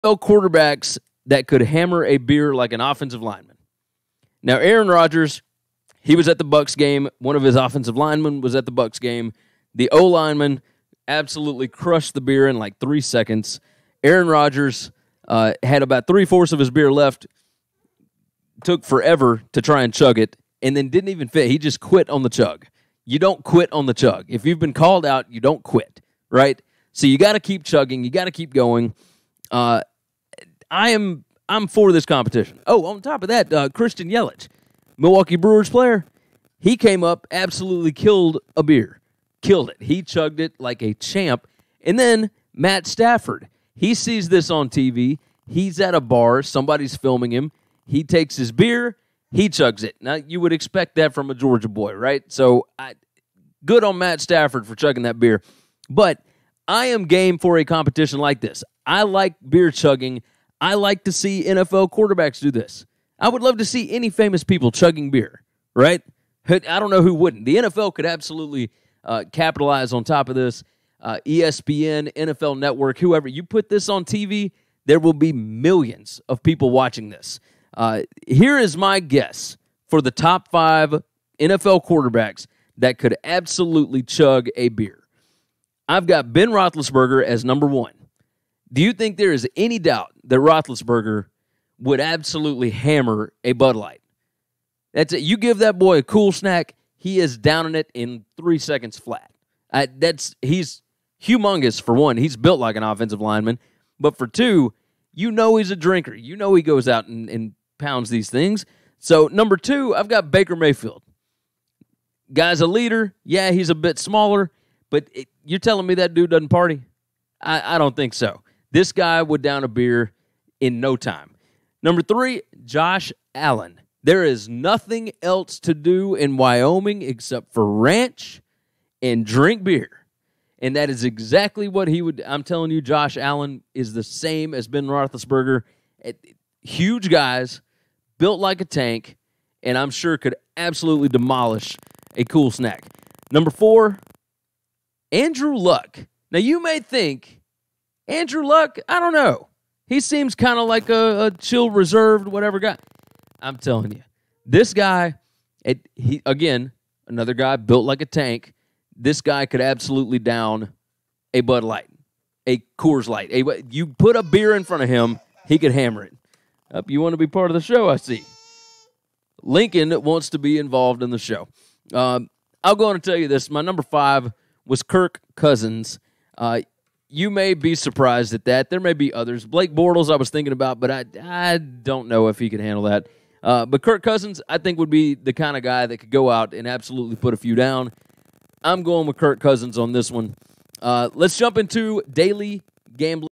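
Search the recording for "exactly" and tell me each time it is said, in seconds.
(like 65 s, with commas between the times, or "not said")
131 s.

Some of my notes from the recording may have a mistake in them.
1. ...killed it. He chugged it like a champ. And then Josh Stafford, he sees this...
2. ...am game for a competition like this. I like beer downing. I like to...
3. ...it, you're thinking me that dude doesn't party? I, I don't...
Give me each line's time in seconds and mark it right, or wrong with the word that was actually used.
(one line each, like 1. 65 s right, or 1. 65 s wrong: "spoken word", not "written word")
1. 39 s wrong: "Matt", not "Josh"
2. 56 s wrong: "chugging", not "downing"
3. 115 s wrong: "telling", not "thinking".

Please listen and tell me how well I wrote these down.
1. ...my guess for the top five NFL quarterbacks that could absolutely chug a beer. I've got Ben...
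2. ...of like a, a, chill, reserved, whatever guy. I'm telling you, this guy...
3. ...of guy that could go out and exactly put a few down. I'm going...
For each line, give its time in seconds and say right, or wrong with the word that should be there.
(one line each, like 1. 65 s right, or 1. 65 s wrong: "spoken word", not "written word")
1. 78 s right
2. 150 s right
3. 185 s wrong: "absolutely", not "exactly".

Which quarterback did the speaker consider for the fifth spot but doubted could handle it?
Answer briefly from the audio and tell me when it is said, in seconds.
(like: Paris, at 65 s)
Blake Bortles, at 179 s.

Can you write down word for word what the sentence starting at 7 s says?
One of his offensive linemen was at the Bucks game.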